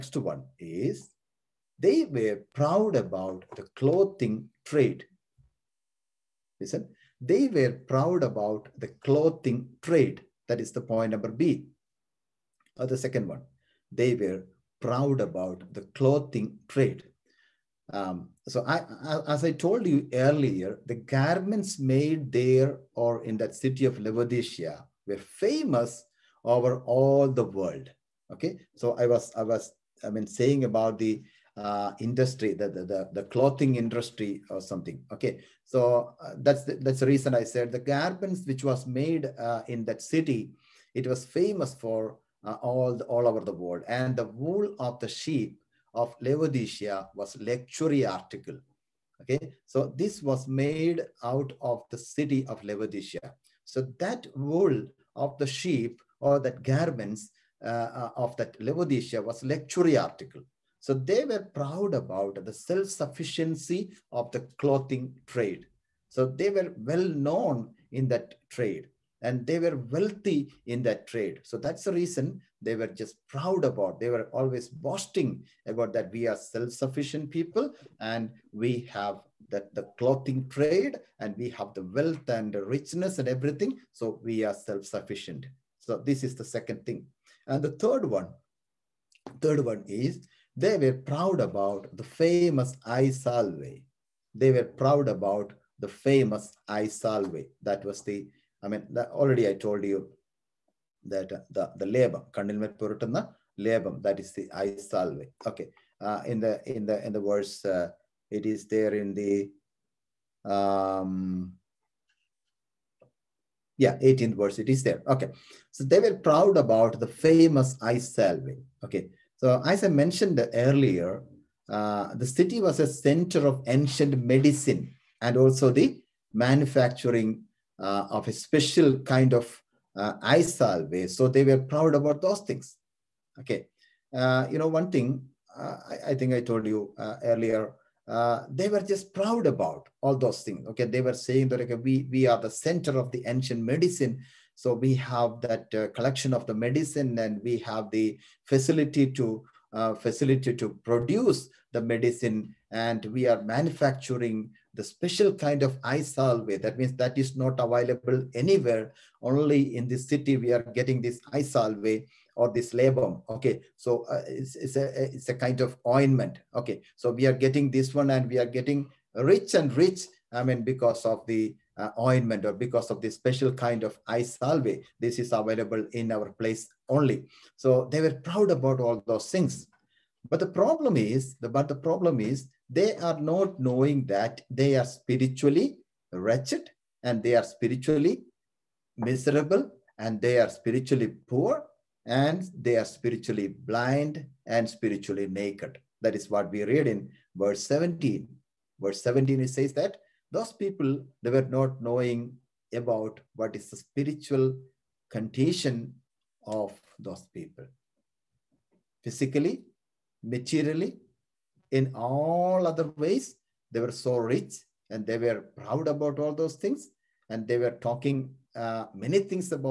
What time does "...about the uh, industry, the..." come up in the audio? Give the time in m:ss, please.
0:30.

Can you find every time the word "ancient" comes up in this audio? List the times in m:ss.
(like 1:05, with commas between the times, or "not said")
2:03, 2:23.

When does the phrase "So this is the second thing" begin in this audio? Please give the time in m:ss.
1:25.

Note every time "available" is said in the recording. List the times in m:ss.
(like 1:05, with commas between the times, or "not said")
2:37, 2:55.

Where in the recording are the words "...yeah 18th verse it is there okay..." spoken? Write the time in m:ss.
1:53.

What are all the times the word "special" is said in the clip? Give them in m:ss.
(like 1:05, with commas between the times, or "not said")
2:08, 2:34, 2:53.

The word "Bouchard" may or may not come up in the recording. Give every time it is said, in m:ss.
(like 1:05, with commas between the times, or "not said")
not said.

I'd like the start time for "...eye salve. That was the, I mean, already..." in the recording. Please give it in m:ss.
1:36.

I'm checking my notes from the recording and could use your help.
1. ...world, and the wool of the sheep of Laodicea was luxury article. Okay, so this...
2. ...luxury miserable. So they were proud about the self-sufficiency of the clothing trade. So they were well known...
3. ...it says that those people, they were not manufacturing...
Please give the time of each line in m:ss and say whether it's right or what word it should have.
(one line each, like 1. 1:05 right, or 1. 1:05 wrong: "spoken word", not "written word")
1. 0:43 right
2. 0:59 wrong: "article", not "miserable"
3. 3:19 wrong: "knowing", not "manufacturing".